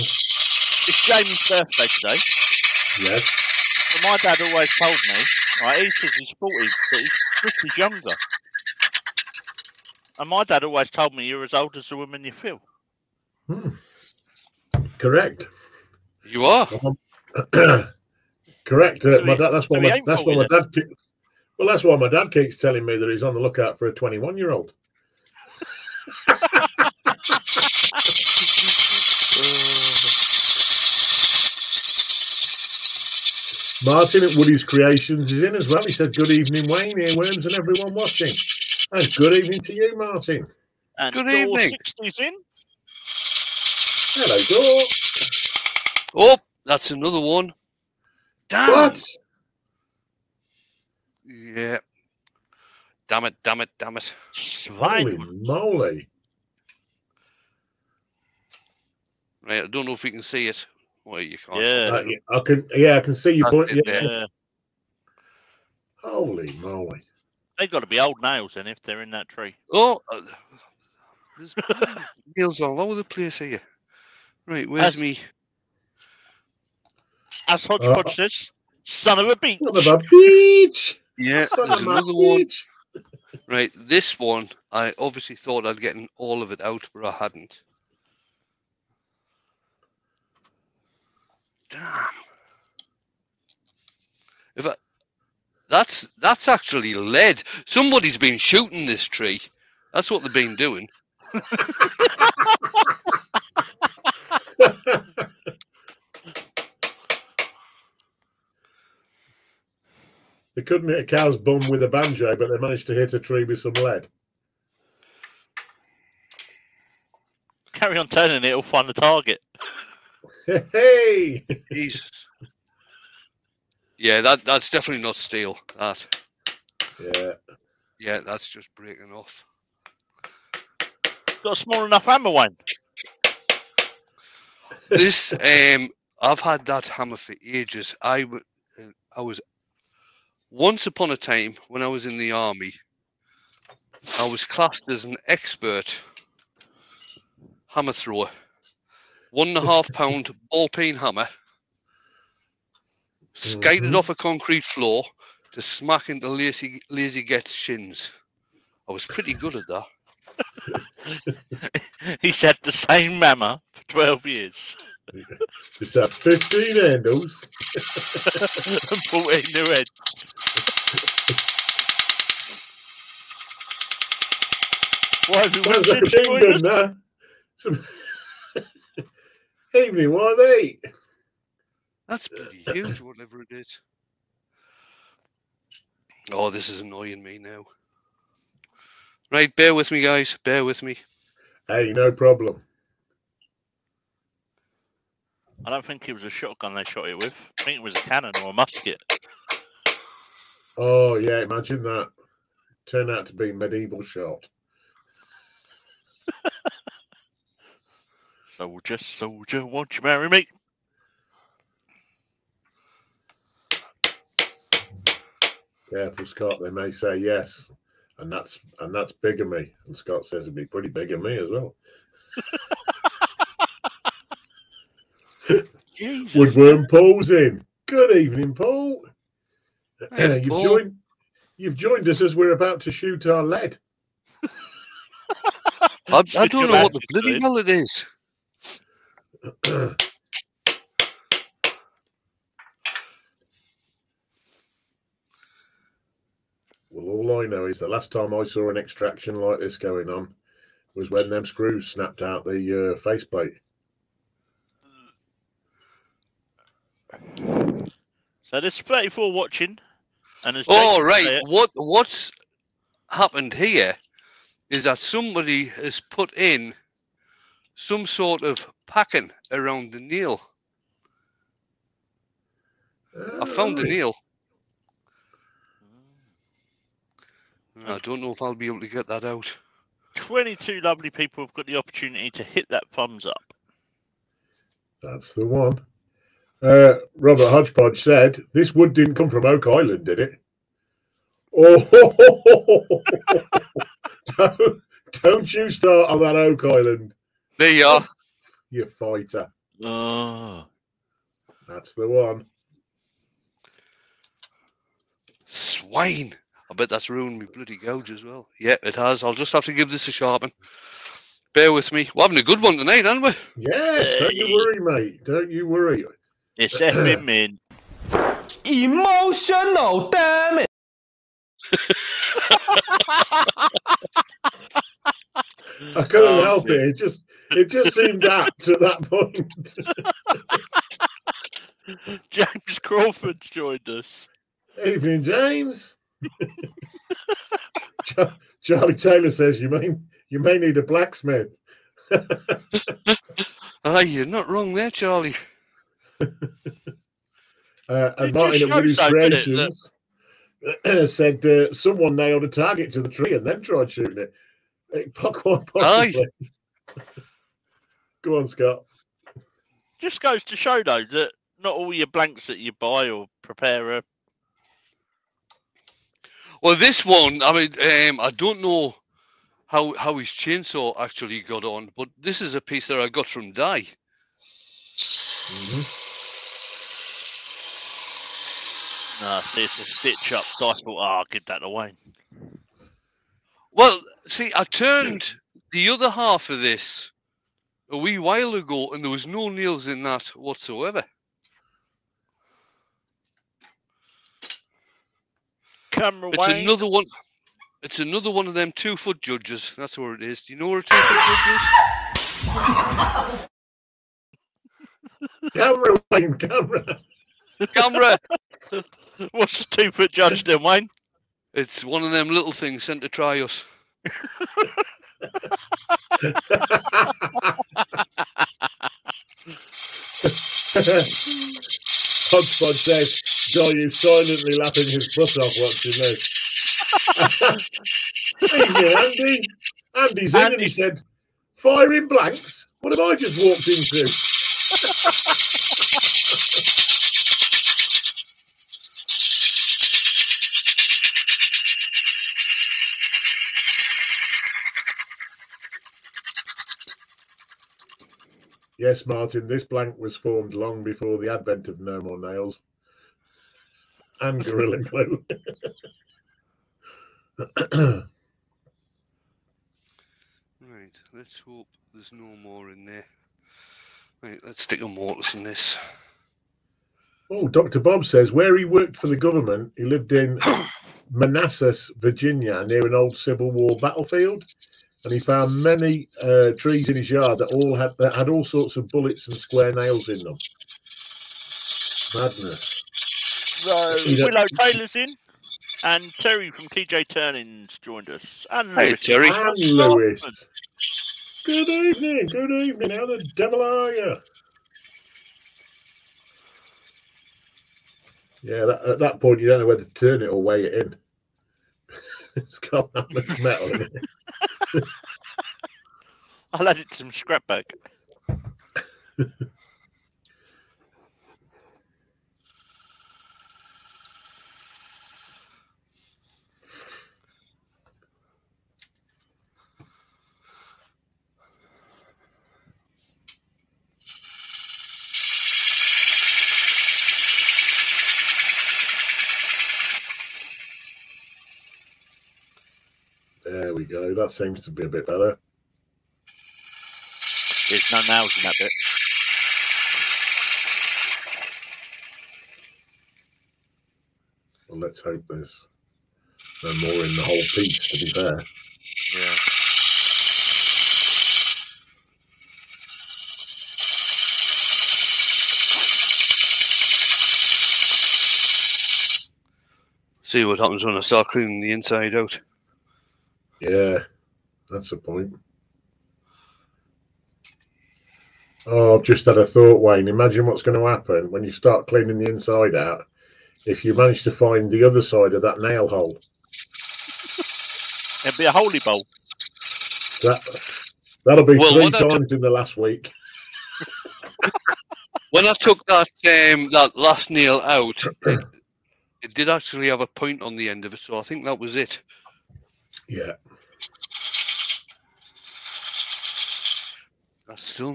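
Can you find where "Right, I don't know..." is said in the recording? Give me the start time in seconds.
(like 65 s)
59 s.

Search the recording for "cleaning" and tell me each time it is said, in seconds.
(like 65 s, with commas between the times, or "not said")
561 s, 571 s.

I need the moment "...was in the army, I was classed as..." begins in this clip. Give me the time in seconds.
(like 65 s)
141 s.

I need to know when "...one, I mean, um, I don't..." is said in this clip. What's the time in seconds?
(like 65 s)
367 s.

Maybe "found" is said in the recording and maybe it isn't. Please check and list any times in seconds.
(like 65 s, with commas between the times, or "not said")
273 s, 475 s.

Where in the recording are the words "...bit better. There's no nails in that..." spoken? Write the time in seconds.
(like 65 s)
534 s.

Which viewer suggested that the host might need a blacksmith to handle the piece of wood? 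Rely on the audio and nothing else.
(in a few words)
Charlie Taylor.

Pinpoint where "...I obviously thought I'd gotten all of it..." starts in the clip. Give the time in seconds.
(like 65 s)
84 s.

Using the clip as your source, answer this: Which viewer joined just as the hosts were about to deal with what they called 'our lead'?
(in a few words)
Woodworm Paul.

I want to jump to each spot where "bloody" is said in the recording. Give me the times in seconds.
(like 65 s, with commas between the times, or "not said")
237 s, 307 s.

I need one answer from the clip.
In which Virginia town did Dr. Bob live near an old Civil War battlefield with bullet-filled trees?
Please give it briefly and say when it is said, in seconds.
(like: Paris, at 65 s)
Manassas, at 471 s.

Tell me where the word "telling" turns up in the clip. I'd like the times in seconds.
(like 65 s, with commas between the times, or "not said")
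22 s.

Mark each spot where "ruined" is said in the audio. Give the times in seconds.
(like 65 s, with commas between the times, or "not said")
307 s.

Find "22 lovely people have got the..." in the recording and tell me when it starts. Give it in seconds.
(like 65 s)
280 s.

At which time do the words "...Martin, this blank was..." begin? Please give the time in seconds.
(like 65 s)
449 s.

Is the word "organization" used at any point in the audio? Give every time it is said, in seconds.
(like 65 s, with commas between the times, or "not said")
not said.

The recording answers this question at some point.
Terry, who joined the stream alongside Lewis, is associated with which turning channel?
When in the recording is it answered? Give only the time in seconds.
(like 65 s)
486 s.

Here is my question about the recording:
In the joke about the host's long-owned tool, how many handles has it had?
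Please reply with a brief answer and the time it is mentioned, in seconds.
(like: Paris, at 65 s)
15, at 166 s.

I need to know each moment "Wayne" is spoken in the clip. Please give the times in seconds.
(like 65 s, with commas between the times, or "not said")
36 s, 406 s, 410 s, 569 s.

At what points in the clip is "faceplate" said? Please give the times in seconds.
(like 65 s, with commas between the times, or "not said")
252 s.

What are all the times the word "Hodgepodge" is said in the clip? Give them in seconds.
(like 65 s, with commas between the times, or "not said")
77 s, 287 s, 422 s.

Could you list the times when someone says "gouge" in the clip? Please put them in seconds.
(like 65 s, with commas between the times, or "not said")
307 s.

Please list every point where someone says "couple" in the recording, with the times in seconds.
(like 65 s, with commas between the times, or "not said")
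not said.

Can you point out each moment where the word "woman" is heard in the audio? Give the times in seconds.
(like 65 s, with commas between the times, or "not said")
11 s.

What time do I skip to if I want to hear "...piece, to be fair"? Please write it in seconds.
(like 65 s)
547 s.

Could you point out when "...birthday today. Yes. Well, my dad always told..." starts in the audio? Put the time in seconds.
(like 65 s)
1 s.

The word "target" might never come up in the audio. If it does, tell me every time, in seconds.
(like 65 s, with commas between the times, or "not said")
118 s, 352 s.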